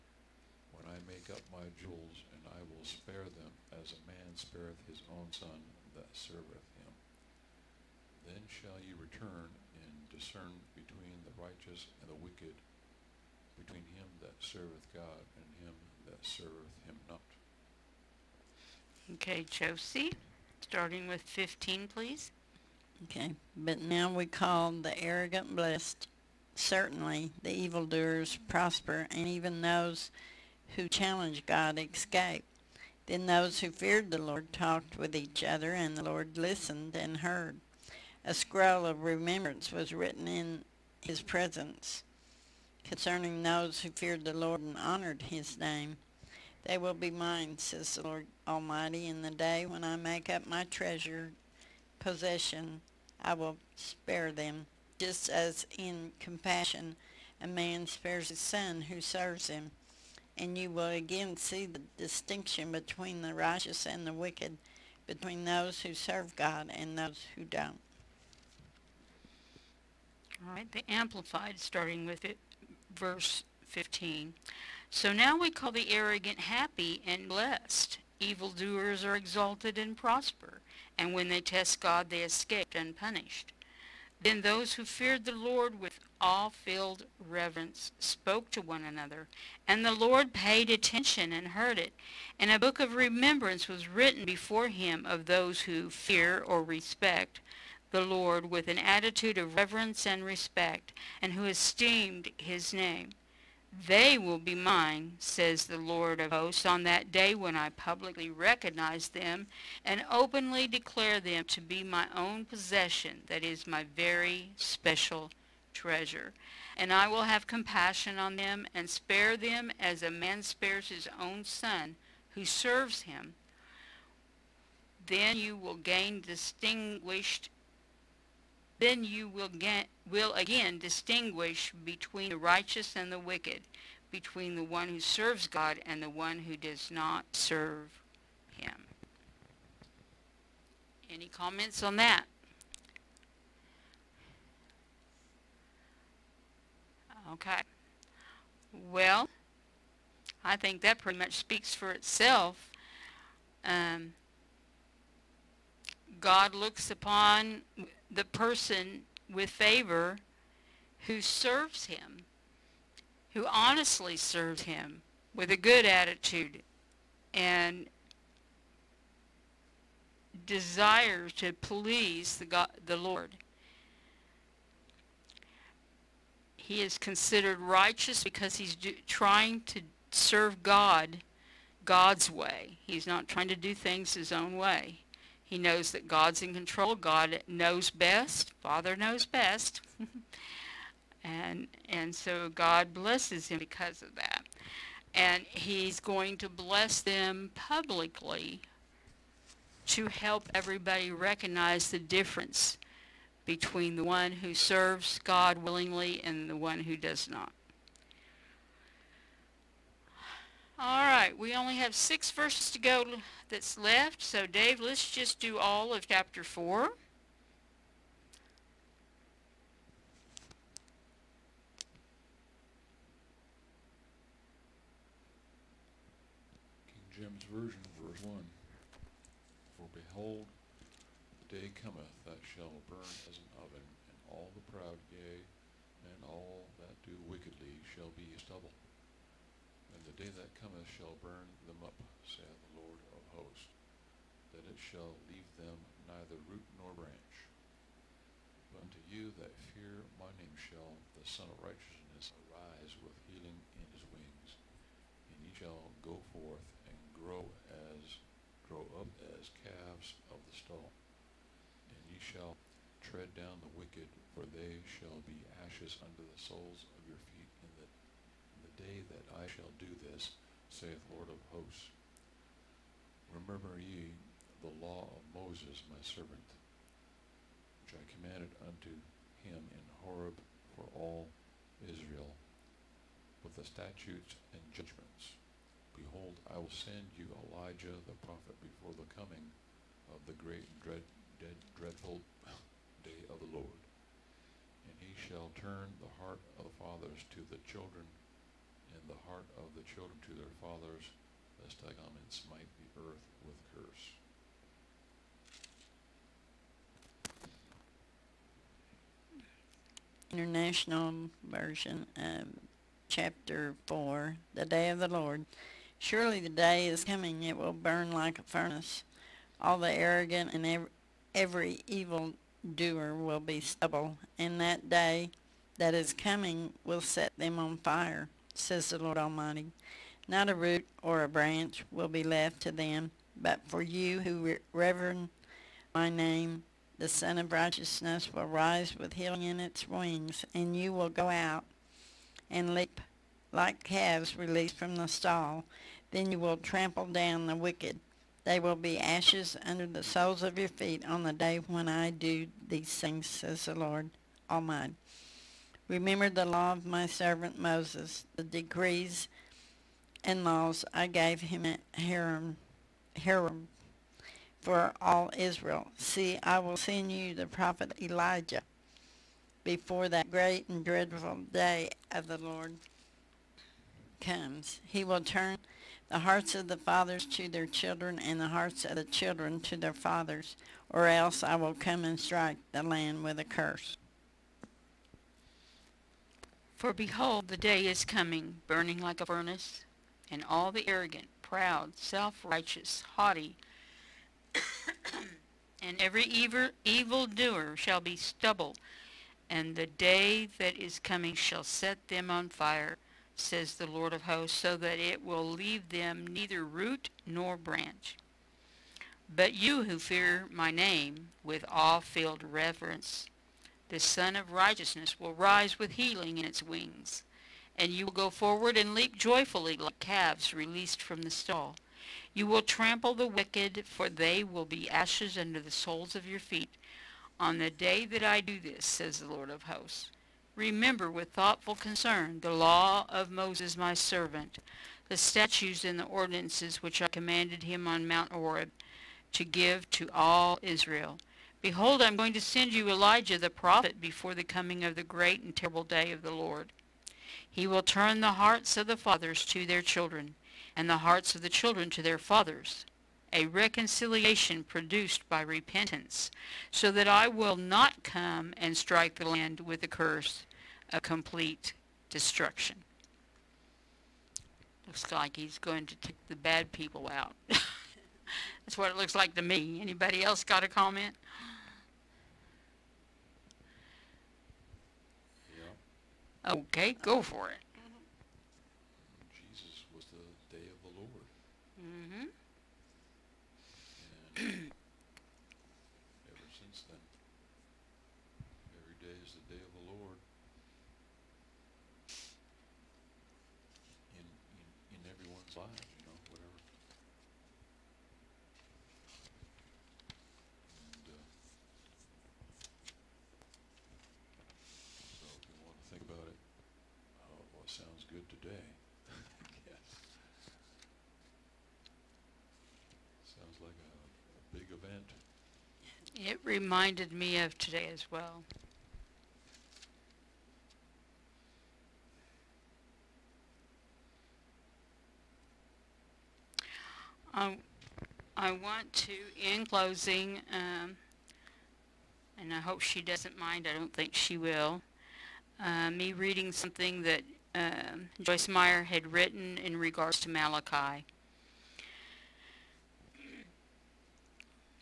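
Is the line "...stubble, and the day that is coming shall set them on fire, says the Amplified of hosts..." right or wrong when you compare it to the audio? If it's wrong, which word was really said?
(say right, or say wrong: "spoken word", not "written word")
wrong: "Lord", not "Amplified".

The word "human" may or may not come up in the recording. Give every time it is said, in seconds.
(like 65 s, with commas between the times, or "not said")
not said.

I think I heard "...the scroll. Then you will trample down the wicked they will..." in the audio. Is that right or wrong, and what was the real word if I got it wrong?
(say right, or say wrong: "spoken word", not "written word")
wrong: "stall", not "scroll".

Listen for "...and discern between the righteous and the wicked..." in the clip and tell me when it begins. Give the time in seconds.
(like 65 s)
9 s.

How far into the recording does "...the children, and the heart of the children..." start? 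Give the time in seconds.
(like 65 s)
297 s.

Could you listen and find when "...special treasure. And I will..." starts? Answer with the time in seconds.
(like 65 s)
114 s.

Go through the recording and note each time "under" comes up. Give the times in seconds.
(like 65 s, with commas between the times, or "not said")
349 s, 425 s.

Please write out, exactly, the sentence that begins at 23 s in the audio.
Okay, but now we call the arrogant blessed.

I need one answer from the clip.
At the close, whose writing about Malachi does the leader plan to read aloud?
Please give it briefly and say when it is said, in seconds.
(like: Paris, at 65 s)
Joyce Meyer, at 538 s.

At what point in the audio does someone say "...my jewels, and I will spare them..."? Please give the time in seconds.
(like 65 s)
1 s.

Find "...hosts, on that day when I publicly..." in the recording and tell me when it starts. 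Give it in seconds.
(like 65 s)
106 s.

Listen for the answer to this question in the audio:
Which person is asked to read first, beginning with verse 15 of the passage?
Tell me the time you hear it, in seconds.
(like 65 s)
19 s.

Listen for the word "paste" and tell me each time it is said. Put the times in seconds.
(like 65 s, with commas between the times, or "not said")
not said.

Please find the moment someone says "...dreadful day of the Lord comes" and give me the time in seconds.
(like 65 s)
370 s.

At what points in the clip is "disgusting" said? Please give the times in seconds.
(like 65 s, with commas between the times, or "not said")
not said.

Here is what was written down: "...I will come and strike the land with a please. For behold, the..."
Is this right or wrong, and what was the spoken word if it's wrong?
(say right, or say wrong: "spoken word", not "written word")
wrong: "curse", not "please".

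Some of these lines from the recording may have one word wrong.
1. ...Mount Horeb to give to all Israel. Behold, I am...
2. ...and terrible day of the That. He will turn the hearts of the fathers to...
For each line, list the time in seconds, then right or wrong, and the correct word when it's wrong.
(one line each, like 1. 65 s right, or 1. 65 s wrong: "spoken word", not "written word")
1. 438 s right
2. 445 s wrong: "Lord", not "That".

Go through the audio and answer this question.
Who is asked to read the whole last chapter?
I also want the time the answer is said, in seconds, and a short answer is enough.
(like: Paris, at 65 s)
Dave, at 214 s.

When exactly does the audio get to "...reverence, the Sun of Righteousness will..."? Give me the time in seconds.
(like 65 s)
412 s.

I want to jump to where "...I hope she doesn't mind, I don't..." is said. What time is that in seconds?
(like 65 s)
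532 s.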